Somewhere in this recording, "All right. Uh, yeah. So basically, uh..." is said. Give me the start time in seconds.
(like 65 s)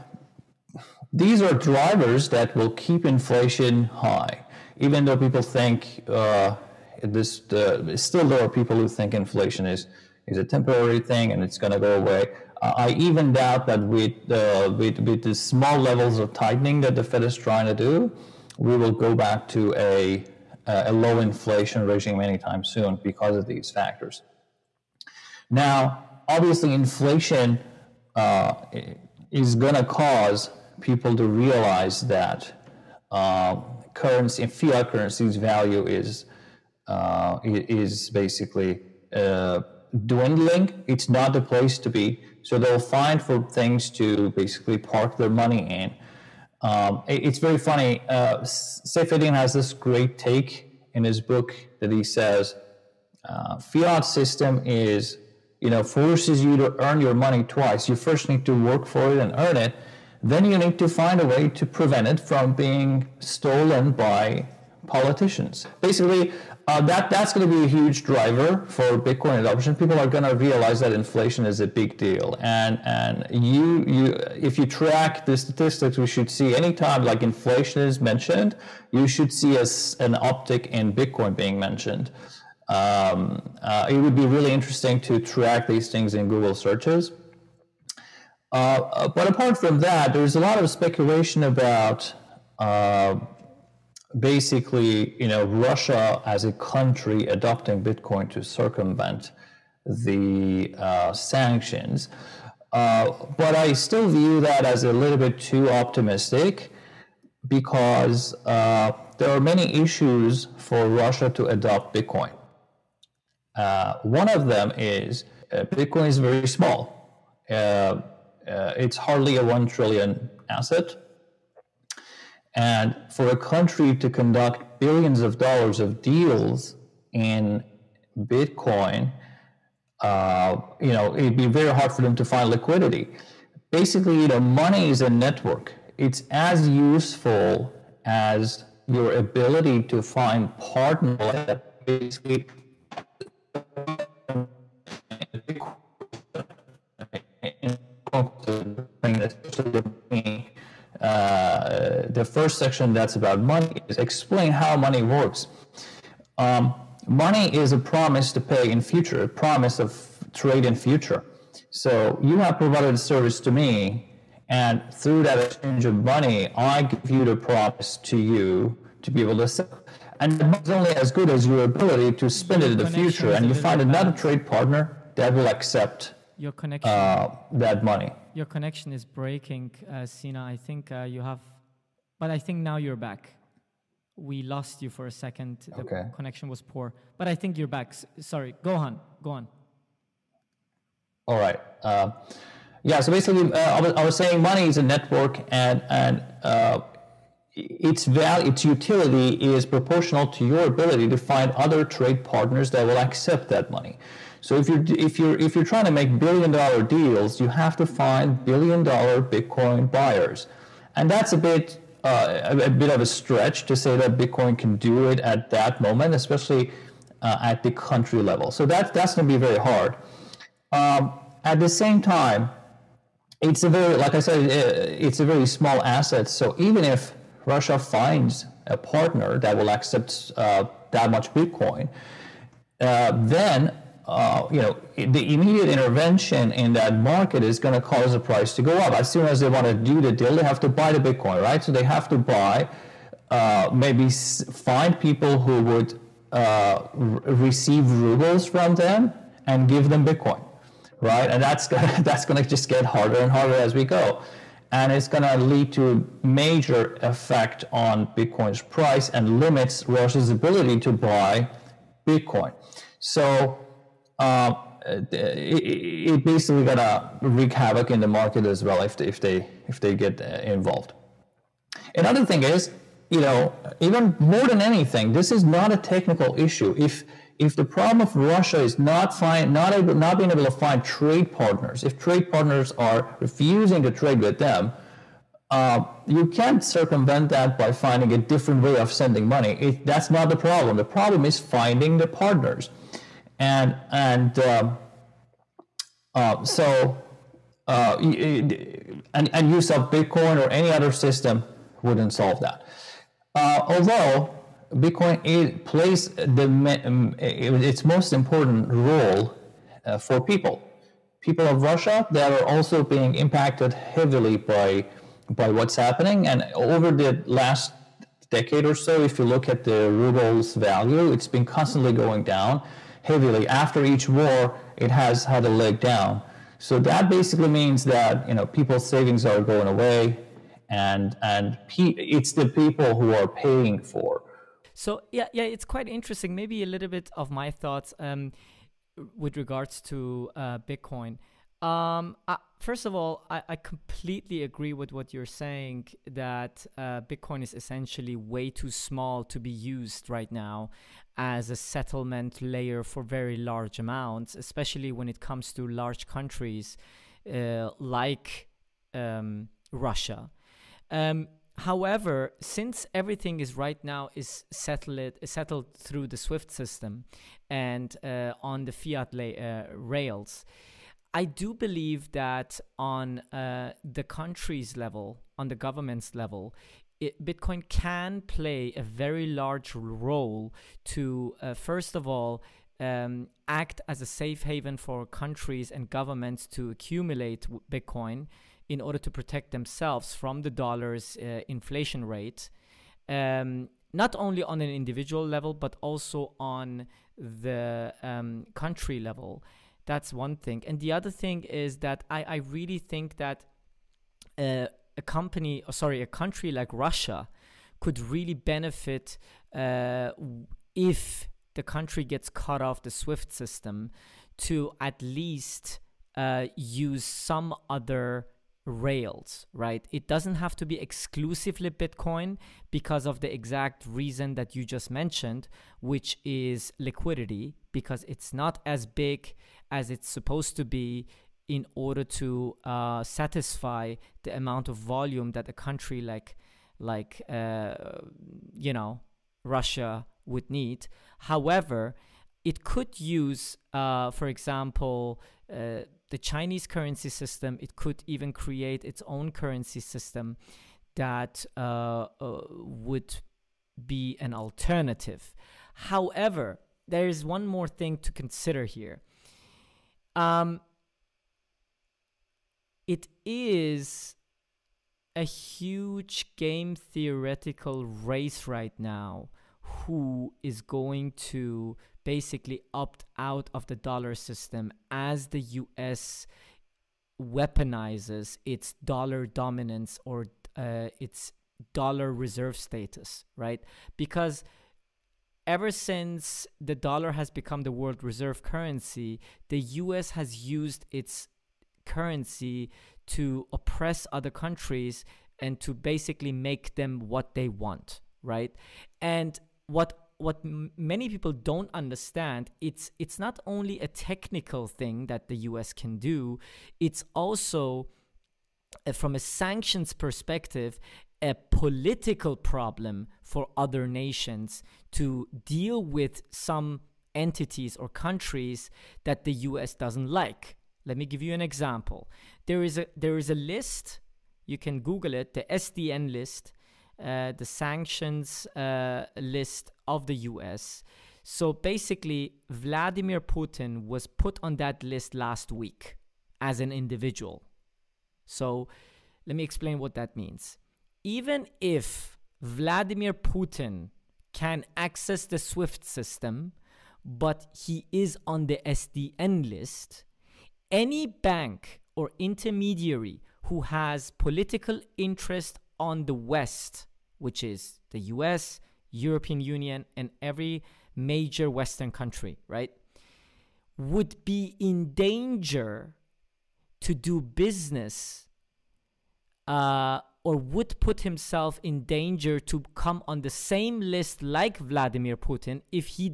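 191 s.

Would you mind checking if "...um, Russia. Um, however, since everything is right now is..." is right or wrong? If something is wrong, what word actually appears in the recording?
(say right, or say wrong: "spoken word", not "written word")
right.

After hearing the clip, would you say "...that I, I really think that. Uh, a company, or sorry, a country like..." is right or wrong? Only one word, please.
right.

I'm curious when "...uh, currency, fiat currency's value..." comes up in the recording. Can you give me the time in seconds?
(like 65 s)
33 s.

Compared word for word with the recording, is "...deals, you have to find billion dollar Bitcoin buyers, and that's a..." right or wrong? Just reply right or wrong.
right.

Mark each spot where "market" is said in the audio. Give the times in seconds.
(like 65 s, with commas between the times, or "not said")
236 s, 268 s.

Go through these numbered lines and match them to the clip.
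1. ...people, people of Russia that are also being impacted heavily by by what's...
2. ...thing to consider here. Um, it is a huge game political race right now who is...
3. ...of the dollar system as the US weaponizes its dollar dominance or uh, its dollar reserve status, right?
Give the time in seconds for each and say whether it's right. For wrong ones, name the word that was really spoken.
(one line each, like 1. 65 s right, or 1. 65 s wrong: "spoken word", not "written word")
1. 310 s right
2. 457 s wrong: "theoretical", not "political"
3. 473 s right.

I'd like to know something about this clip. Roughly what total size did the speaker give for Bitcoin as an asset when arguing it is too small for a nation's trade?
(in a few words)
one trillion.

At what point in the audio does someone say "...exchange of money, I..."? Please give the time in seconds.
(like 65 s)
165 s.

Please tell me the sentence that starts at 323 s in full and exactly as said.
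After each war, it has had a leg down.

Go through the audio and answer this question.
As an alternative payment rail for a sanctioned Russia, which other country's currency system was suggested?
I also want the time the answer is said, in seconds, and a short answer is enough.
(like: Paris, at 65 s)
Chinese, at 446 s.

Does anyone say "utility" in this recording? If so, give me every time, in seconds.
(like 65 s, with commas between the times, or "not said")
198 s.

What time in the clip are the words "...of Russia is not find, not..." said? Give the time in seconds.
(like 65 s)
278 s.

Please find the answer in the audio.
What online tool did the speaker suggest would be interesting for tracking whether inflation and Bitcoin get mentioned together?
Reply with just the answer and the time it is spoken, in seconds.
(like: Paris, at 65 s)
Google searches, at 86 s.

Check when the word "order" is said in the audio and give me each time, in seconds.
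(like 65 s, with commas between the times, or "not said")
388 s, 431 s.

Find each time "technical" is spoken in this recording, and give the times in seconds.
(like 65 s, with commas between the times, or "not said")
275 s, 503 s.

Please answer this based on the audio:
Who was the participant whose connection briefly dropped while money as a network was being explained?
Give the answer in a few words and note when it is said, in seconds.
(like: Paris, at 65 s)
Sina, at 180 s.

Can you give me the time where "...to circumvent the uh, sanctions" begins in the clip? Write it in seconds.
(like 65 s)
98 s.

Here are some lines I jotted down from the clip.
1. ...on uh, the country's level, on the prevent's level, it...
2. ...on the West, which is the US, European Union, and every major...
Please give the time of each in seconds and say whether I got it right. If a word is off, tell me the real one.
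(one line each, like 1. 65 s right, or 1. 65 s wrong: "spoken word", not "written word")
1. 372 s wrong: "government", not "prevent"
2. 555 s right.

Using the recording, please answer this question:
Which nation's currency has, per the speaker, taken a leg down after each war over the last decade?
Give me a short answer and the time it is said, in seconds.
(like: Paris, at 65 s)
ruble, at 319 s.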